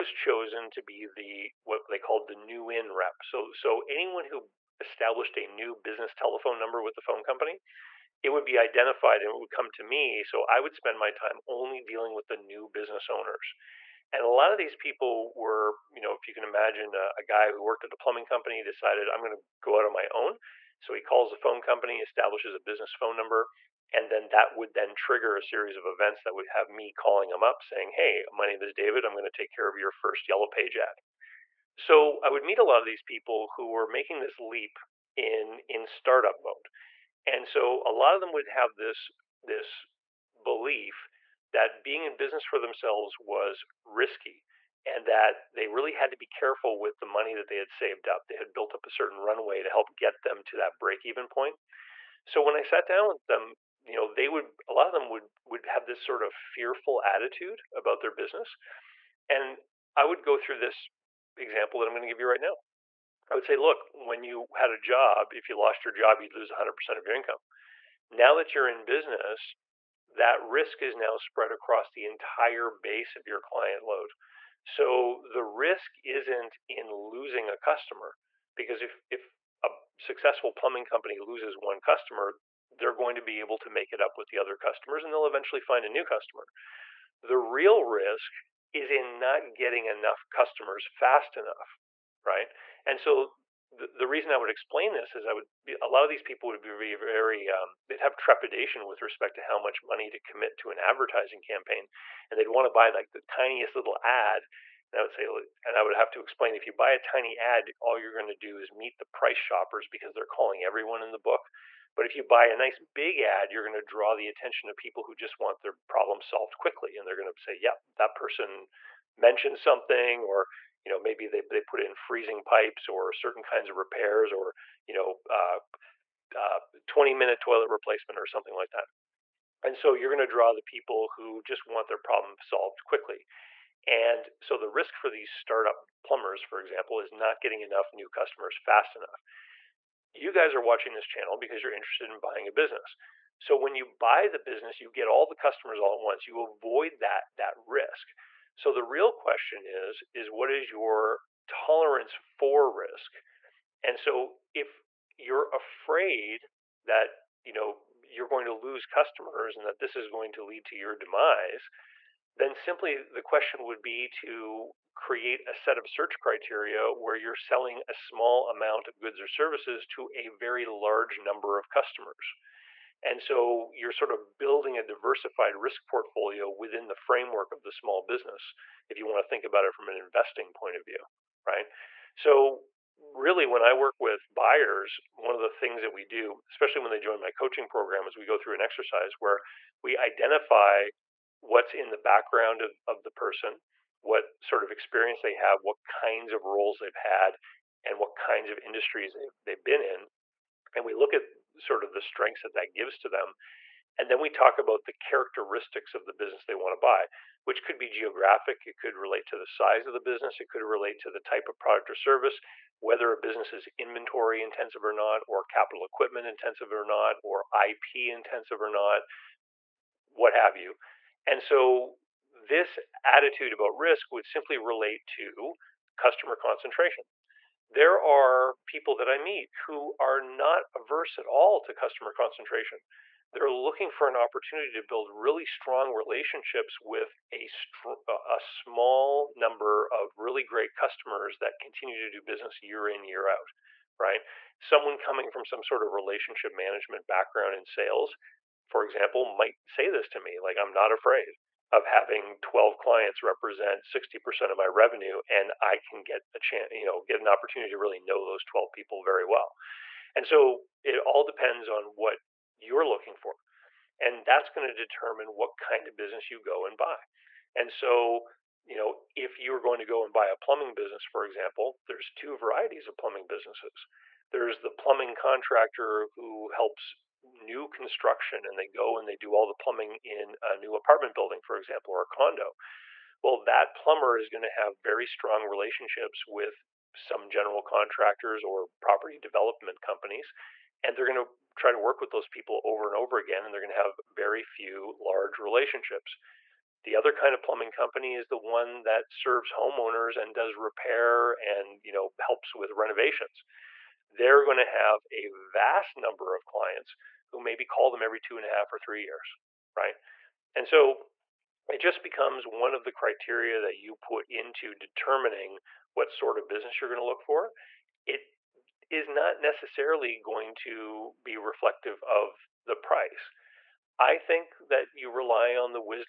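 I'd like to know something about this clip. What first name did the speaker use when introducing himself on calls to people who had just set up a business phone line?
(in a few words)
David.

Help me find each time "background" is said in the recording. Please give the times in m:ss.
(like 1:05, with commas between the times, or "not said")
3:11, 4:07.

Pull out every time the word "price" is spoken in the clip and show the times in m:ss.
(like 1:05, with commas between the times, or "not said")
1:49, 5:22.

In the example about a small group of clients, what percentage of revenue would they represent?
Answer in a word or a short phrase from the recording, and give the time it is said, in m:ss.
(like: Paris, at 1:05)
60%, at 4:13.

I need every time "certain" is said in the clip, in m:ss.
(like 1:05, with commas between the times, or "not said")
0:48, 2:03.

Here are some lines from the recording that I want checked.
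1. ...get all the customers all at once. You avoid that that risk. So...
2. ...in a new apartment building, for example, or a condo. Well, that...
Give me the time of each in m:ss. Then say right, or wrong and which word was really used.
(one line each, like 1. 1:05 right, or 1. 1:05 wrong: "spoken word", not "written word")
1. 2:24 right
2. 4:40 right.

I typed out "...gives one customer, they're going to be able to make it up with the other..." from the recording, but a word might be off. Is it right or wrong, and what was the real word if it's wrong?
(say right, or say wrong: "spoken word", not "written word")
wrong: "loses", not "gives".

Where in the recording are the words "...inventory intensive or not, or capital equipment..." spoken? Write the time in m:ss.
3:33.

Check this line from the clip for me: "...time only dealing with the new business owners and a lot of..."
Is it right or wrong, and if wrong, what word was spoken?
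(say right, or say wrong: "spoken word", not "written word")
right.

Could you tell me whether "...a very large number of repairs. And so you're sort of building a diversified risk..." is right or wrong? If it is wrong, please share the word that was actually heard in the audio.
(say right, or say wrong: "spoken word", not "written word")
wrong: "customers", not "repairs".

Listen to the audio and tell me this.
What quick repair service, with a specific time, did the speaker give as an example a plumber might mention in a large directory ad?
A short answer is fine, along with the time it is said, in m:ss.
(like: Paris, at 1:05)
20 minute toilet replacement, at 2:06.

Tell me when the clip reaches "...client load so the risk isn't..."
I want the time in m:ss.
1:13.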